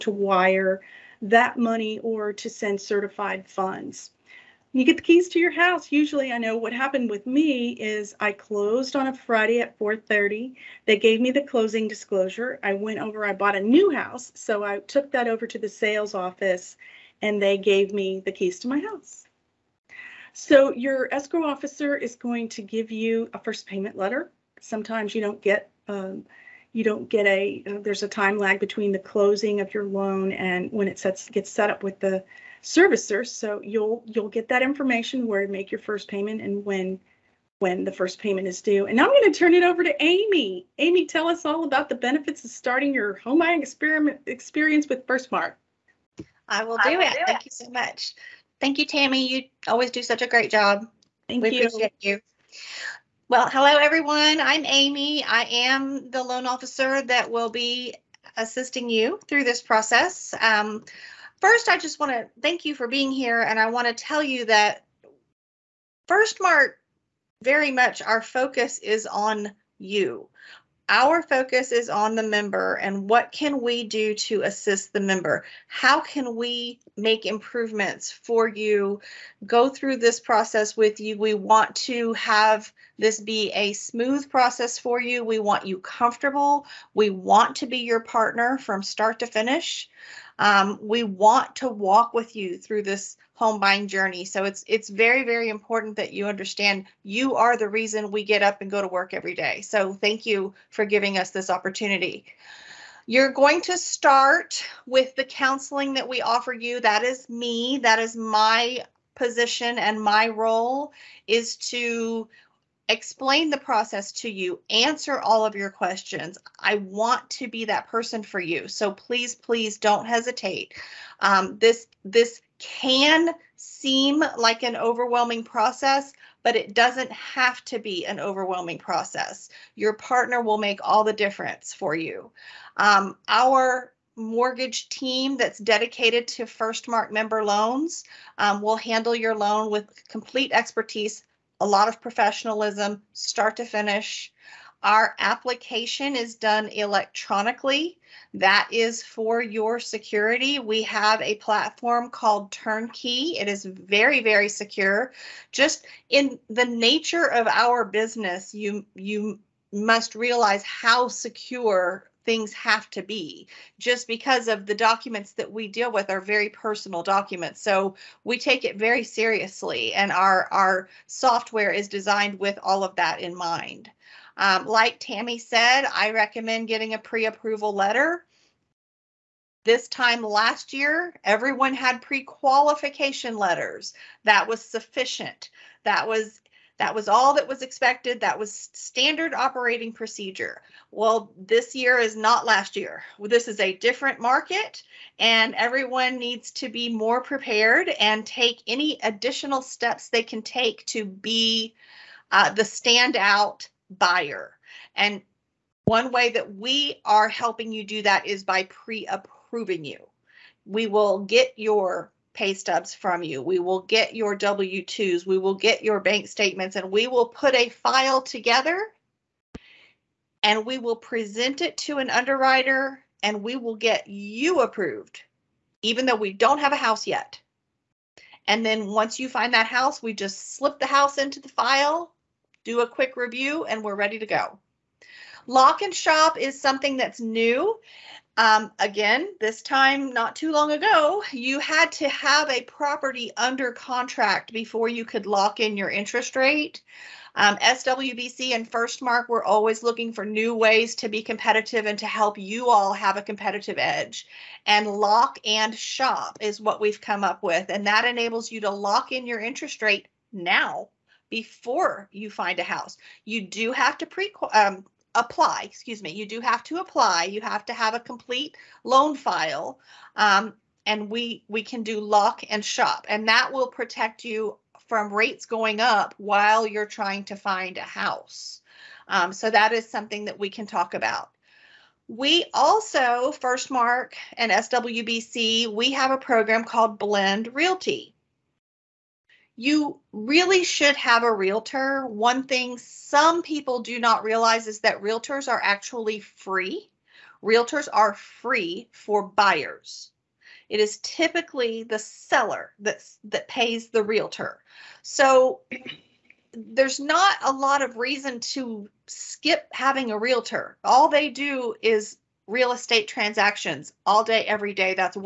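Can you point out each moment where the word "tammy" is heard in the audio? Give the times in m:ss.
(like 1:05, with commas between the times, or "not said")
0:48, 2:54.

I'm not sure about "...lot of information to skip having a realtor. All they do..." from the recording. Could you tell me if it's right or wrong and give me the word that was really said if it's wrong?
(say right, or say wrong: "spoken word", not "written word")
wrong: "reason", not "information".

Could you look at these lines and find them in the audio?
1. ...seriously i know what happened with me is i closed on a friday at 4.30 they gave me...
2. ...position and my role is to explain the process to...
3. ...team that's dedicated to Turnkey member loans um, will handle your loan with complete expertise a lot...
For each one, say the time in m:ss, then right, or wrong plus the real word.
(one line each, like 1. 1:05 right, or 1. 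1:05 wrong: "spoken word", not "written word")
1. 0:05 wrong: "usually", not "seriously"
2. 1:49 right
3. 2:14 wrong: "Firstmark", not "Turnkey".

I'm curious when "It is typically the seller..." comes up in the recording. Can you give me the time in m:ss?
5:00.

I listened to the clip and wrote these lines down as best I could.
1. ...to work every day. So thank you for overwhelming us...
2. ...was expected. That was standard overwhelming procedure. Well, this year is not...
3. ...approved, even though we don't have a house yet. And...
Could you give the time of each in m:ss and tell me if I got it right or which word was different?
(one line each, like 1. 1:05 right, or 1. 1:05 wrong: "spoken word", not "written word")
1. 1:38 wrong: "giving", not "overwhelming"
2. 3:07 wrong: "operating", not "overwhelming"
3. 3:44 right.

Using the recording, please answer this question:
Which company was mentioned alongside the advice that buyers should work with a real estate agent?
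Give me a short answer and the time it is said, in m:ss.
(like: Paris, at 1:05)
Blend Realty, at 4:46.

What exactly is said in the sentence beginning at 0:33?
So you'll you'll get that information where to make your first payment and when when the first payment is due.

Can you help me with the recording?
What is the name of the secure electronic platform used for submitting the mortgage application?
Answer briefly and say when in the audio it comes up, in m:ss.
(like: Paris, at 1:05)
Turnkey, at 2:32.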